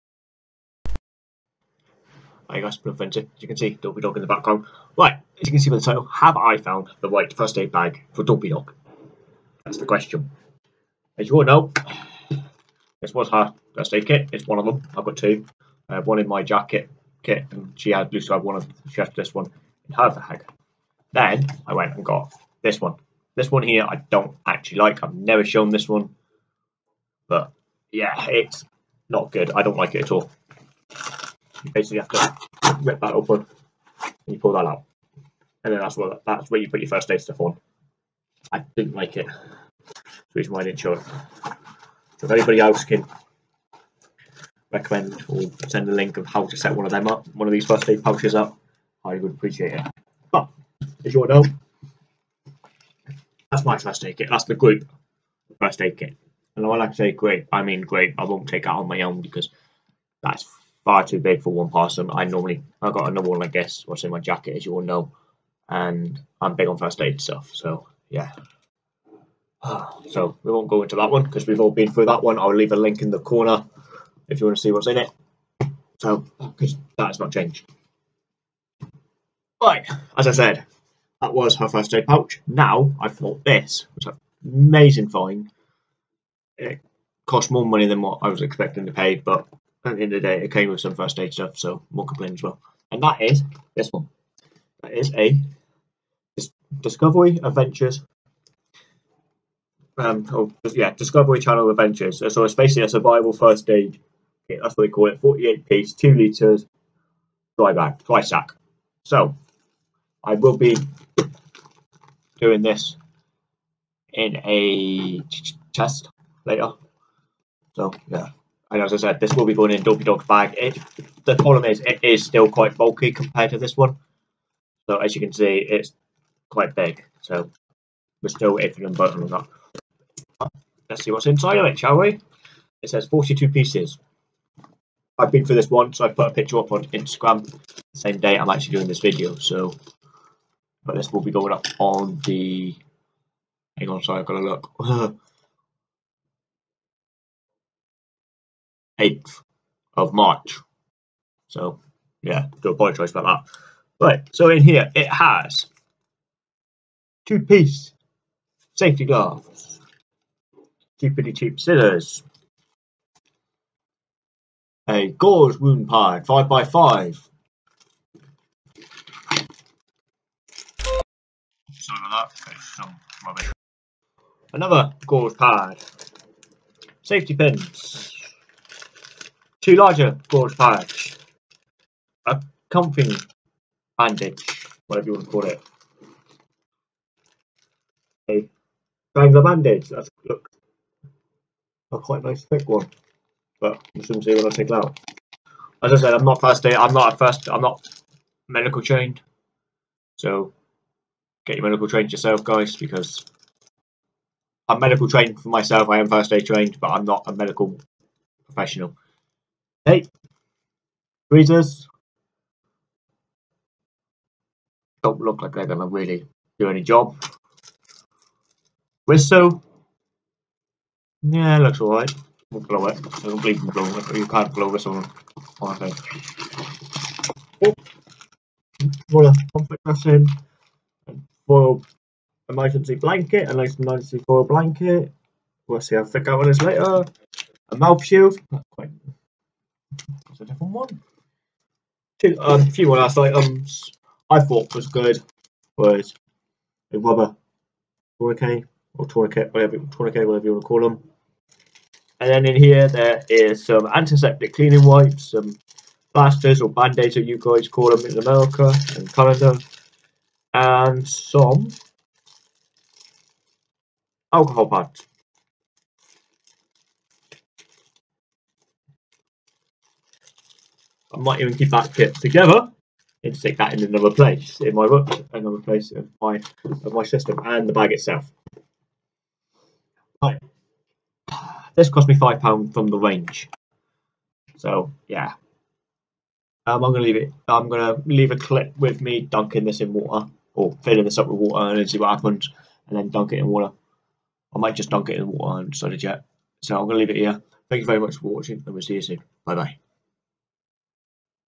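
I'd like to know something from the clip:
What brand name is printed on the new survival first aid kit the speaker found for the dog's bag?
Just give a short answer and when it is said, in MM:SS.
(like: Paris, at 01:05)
Discovery Channel Adventures, at 01:40.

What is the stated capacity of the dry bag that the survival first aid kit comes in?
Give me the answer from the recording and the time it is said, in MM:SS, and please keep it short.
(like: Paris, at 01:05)
2 litres, at 01:45.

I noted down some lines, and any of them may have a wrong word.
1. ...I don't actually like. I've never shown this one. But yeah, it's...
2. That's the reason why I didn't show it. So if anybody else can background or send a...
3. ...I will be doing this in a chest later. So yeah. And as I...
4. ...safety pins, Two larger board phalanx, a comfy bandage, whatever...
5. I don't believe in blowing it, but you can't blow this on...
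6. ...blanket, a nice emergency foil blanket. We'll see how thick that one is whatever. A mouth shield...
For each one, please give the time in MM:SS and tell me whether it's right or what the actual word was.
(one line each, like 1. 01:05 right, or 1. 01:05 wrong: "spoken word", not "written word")
1. 00:23 right
2. 00:39 wrong: "recommend", not "background"
3. 01:50 right
4. 02:57 right
5. 03:43 right
6. 03:52 wrong: "later", not "whatever".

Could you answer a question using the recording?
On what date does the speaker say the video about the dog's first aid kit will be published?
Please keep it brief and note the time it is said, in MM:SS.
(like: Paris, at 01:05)
8th of March, at 02:29.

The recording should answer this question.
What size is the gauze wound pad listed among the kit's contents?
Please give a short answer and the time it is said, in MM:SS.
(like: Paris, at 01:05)
5x5, at 02:46.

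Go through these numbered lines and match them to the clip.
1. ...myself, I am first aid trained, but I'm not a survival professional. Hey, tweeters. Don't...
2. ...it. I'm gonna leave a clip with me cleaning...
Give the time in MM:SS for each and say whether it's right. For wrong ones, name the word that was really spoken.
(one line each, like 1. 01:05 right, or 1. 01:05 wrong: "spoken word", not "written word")
1. 03:25 wrong: "medical", not "survival"
2. 04:47 wrong: "dunking", not "cleaning".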